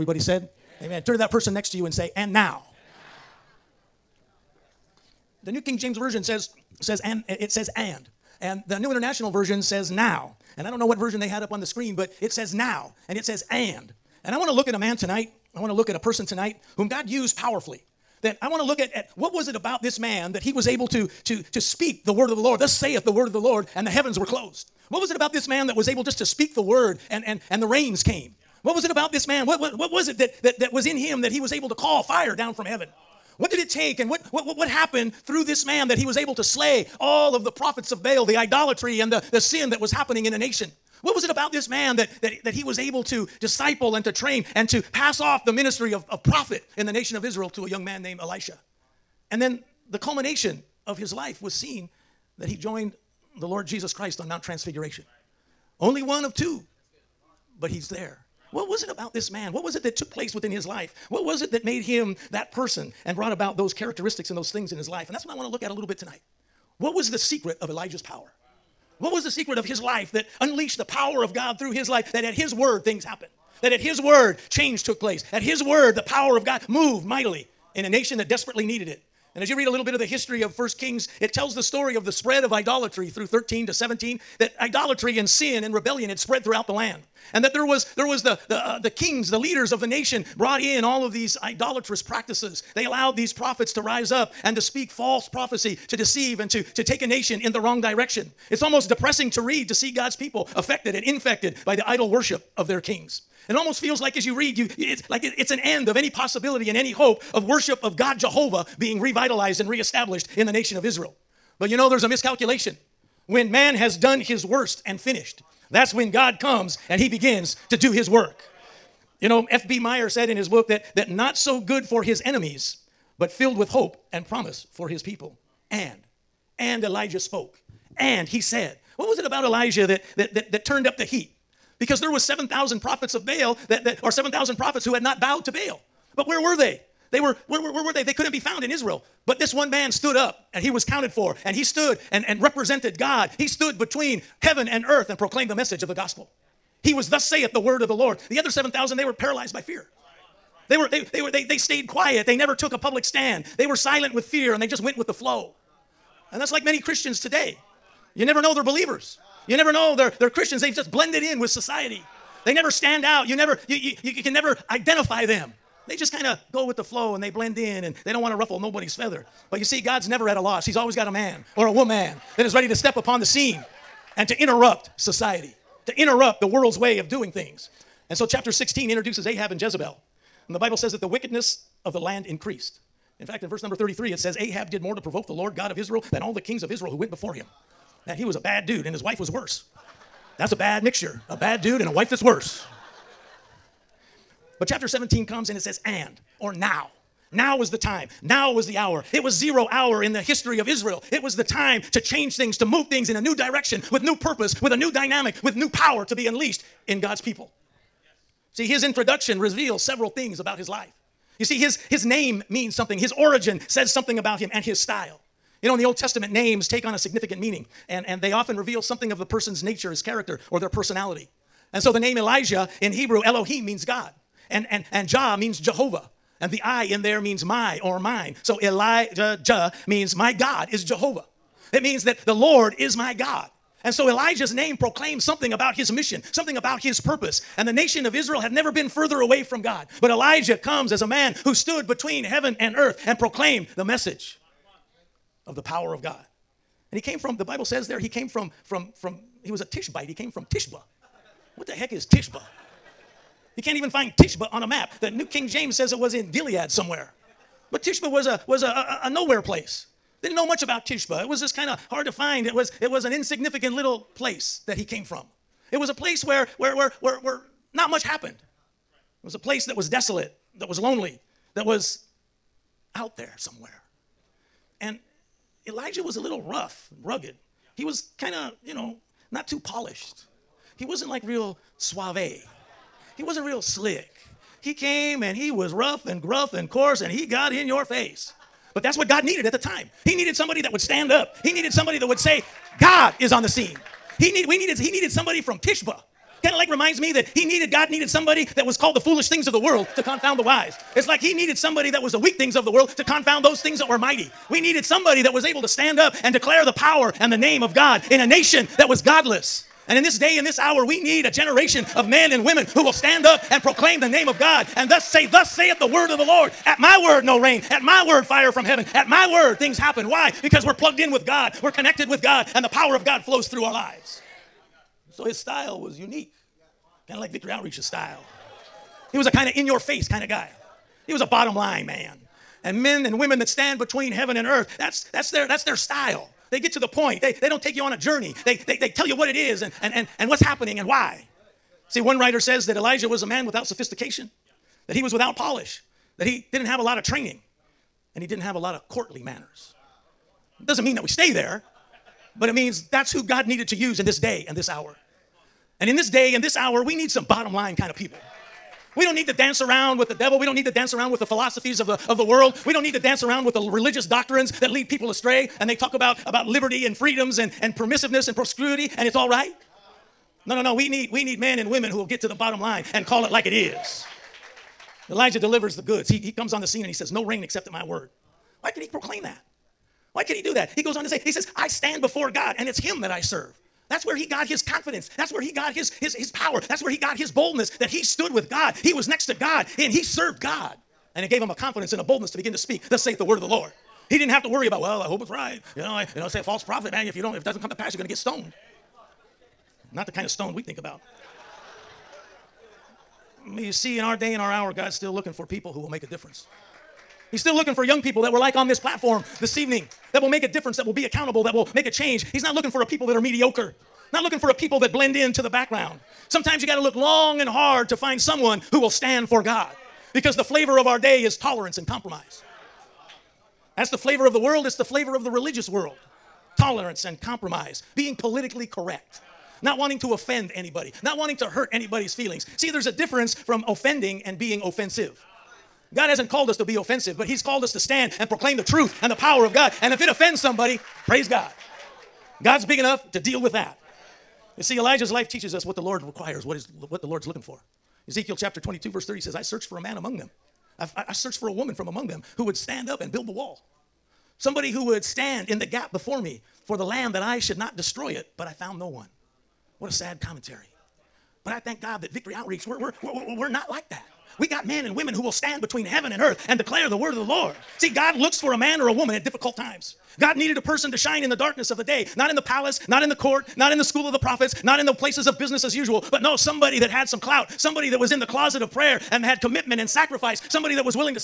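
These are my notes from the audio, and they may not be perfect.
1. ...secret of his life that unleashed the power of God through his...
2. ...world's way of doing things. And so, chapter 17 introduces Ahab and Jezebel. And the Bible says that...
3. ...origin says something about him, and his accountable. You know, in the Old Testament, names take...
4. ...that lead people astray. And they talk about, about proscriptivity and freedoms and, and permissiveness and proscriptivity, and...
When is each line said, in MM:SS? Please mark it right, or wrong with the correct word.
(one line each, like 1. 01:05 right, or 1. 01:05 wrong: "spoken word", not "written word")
1. 01:09 right
2. 02:56 wrong: "16", not "17"
3. 03:33 wrong: "style", not "accountable"
4. 06:04 wrong: "liberty", not "proscriptivity".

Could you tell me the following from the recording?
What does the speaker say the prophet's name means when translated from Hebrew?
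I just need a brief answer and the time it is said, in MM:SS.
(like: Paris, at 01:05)
My God is Jehovah, at 03:50.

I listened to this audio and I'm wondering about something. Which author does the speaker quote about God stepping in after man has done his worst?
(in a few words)
F.B. Meyer.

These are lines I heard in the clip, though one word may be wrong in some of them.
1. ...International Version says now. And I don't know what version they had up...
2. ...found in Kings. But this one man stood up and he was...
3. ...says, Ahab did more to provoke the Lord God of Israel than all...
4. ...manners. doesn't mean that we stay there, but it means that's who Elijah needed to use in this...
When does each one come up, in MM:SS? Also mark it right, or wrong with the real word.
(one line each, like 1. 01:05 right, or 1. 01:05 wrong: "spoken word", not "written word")
1. 00:08 right
2. 02:18 wrong: "Israel", not "Kings"
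3. 03:04 right
4. 05:49 wrong: "God", not "Elijah".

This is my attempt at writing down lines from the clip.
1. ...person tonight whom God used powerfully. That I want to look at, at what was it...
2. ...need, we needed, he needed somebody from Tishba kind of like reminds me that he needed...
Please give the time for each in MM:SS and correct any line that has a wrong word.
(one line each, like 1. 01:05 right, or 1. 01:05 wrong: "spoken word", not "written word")
1. 00:15 right
2. 04:54 right.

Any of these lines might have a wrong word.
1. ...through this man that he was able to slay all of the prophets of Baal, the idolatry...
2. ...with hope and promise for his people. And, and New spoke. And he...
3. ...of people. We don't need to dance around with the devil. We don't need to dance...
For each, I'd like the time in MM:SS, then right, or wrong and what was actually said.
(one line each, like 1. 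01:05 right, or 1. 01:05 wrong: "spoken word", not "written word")
1. 00:35 right
2. 02:03 wrong: "Elijah", not "New"
3. 05:57 right.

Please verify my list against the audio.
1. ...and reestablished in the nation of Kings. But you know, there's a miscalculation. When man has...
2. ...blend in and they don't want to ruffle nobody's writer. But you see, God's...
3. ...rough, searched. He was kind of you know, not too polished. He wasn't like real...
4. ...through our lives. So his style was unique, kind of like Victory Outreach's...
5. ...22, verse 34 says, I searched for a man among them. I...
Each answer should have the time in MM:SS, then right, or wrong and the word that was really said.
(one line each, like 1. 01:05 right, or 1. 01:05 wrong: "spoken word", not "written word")
1. 01:49 wrong: "Israel", not "Kings"
2. 02:47 wrong: "feather", not "writer"
3. 04:36 wrong: "rugged", not "searched"
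4. 05:23 right
5. 07:28 wrong: "30", not "34".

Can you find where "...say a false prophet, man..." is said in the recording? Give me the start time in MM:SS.
06:36.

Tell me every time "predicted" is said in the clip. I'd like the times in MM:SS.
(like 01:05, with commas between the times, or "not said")
not said.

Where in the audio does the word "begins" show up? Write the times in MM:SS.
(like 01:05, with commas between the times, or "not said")
01:57, 06:32.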